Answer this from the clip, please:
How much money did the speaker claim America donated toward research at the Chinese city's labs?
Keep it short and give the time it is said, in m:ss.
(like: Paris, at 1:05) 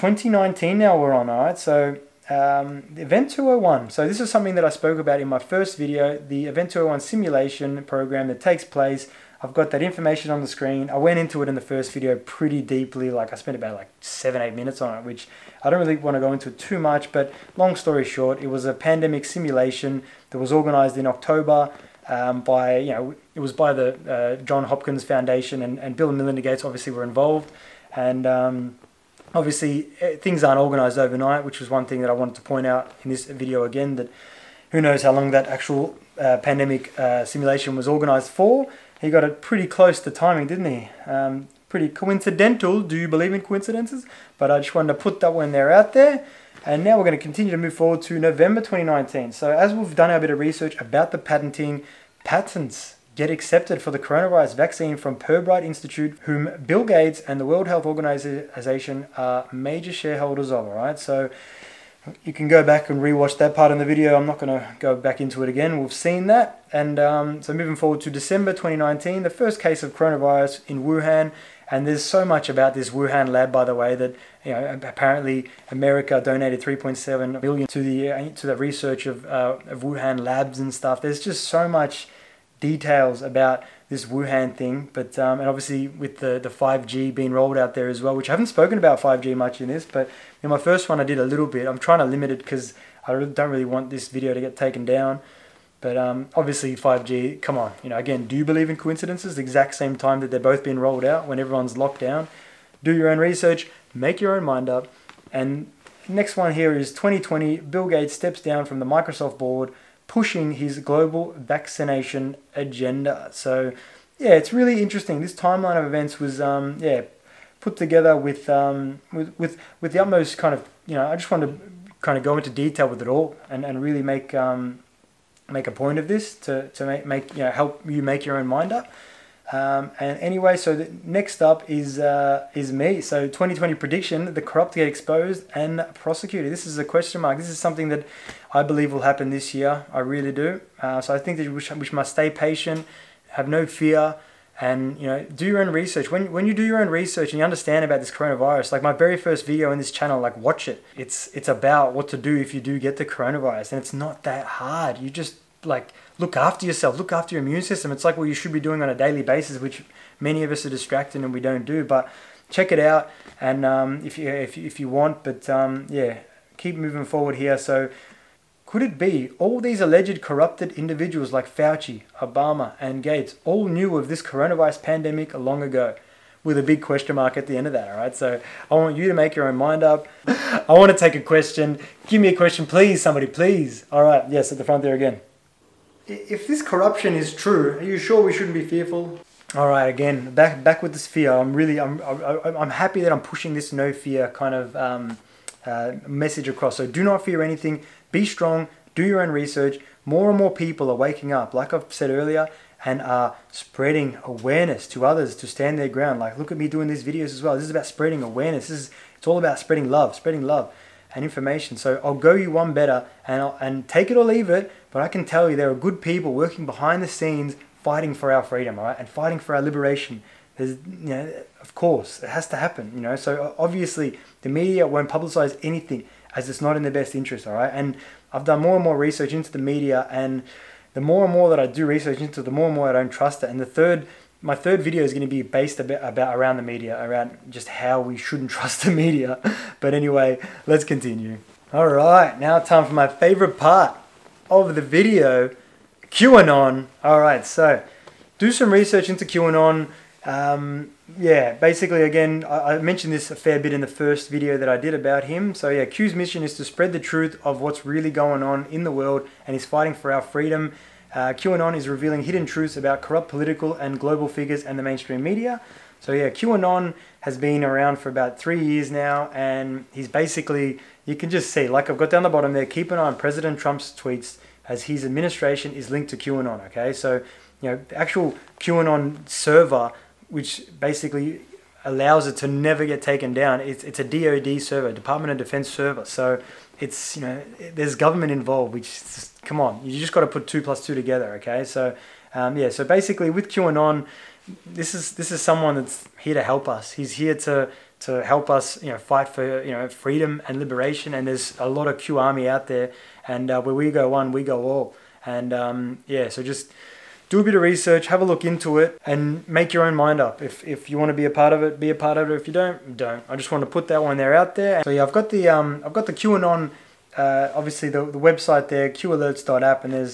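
3.7 billion, at 1:16.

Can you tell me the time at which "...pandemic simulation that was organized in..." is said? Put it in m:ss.
0:18.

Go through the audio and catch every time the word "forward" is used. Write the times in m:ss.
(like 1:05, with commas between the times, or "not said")
0:47, 1:07, 2:47.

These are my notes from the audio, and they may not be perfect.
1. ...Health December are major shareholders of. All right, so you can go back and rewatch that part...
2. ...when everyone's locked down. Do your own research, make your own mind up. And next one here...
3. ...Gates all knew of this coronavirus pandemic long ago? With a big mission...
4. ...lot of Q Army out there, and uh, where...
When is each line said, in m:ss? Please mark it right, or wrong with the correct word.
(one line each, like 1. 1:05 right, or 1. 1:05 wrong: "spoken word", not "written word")
1. 0:57 wrong: "Organization", not "December"
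2. 1:41 right
3. 2:53 wrong: "question", not "mission"
4. 5:01 right.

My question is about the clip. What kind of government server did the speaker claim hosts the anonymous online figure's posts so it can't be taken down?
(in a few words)
Department of Defense server.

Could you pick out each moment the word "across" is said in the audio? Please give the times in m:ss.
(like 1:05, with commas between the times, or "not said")
3:16.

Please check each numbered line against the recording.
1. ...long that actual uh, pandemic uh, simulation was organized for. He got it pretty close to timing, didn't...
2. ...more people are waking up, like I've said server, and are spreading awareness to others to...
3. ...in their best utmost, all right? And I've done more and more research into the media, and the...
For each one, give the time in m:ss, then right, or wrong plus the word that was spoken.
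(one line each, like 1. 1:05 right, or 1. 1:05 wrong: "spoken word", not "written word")
1. 0:35 right
2. 3:20 wrong: "earlier", not "server"
3. 3:46 wrong: "interest", not "utmost".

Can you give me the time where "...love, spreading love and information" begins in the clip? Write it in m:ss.
3:29.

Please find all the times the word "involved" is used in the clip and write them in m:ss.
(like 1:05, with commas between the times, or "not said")
0:27, 4:48.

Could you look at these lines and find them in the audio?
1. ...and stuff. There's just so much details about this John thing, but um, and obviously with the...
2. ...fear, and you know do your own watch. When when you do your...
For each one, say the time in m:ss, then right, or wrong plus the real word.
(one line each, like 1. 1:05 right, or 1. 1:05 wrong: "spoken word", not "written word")
1. 1:20 wrong: "Wuhan", not "John"
2. 2:23 wrong: "research", not "watch".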